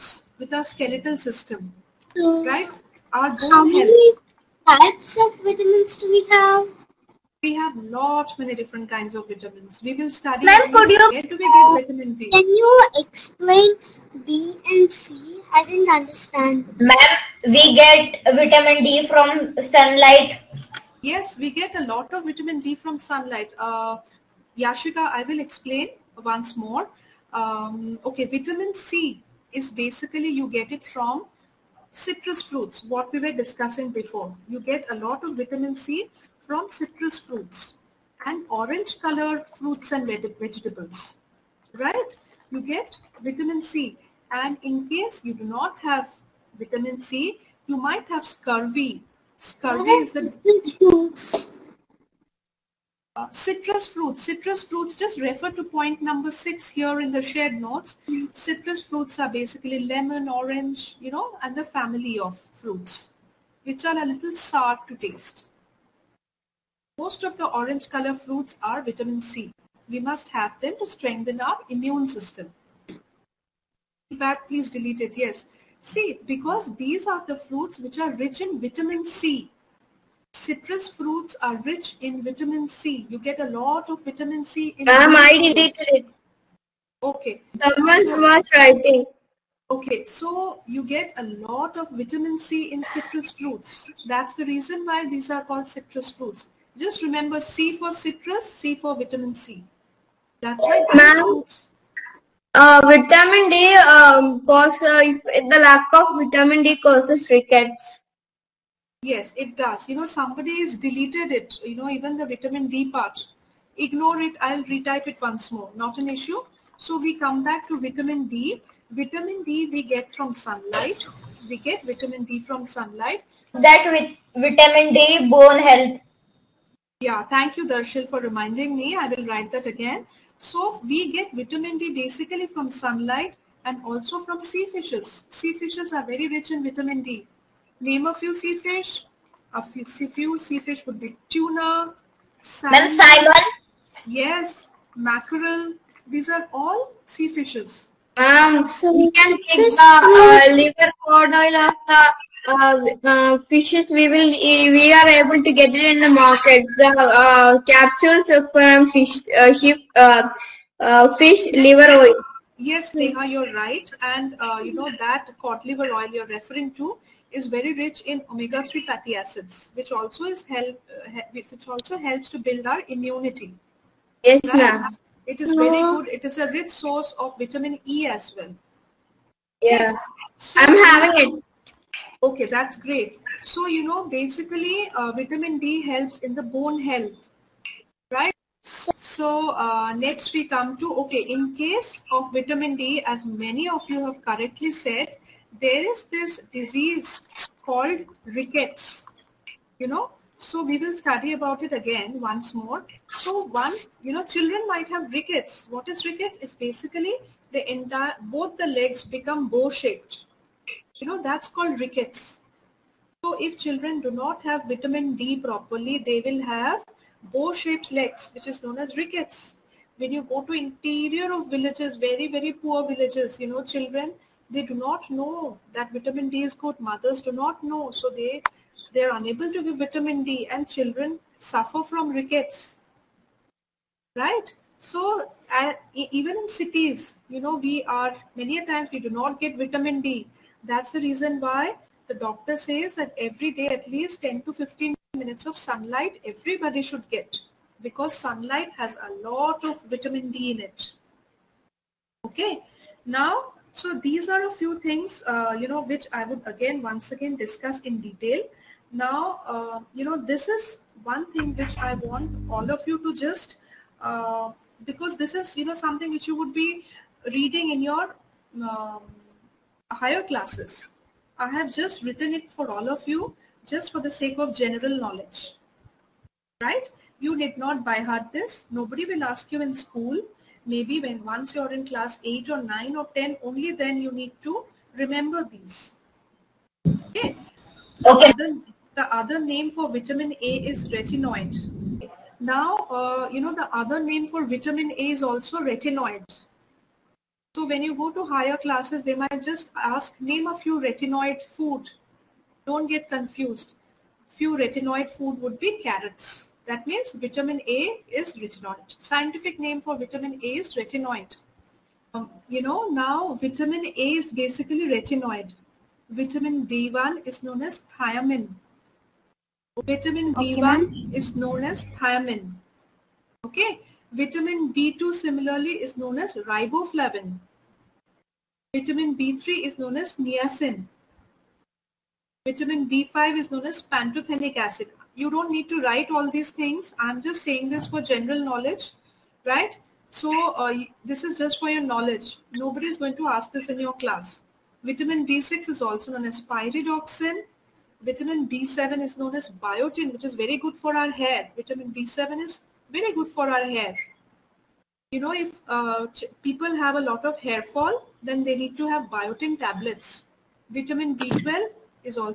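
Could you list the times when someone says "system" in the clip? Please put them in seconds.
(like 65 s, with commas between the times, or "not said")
1 s, 72 s.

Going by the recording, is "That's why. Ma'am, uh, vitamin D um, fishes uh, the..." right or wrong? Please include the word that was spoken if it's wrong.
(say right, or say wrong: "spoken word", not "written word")
wrong: "causes", not "fishes".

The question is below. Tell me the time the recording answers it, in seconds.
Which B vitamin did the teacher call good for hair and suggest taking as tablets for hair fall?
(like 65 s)
348 s.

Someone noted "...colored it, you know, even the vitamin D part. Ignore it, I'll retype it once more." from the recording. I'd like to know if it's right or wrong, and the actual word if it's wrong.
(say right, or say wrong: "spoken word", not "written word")
wrong: "deleted", not "colored".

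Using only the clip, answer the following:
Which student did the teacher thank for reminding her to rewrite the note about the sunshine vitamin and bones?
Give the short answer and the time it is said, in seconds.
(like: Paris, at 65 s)
Darshil, at 127 s.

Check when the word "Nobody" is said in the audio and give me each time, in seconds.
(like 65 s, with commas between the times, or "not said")
278 s, 342 s.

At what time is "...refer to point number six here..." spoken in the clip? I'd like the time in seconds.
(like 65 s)
55 s.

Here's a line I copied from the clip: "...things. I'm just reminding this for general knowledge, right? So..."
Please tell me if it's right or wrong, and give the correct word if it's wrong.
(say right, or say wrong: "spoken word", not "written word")
wrong: "saying", not "reminding".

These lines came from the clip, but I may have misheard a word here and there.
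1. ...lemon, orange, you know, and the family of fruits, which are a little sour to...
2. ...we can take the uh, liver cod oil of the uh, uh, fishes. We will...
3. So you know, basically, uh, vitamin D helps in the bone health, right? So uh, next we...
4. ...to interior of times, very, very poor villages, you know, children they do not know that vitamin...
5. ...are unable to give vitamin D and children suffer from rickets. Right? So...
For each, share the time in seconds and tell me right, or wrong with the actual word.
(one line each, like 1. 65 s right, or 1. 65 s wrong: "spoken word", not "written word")
1. 59 s right
2. 148 s right
3. 183 s right
4. 220 s wrong: "villages", not "times"
5. 229 s right.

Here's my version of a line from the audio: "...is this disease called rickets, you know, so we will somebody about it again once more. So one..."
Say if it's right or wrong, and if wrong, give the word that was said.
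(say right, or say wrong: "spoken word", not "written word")
wrong: "study", not "somebody".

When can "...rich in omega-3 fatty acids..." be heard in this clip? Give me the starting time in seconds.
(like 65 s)
167 s.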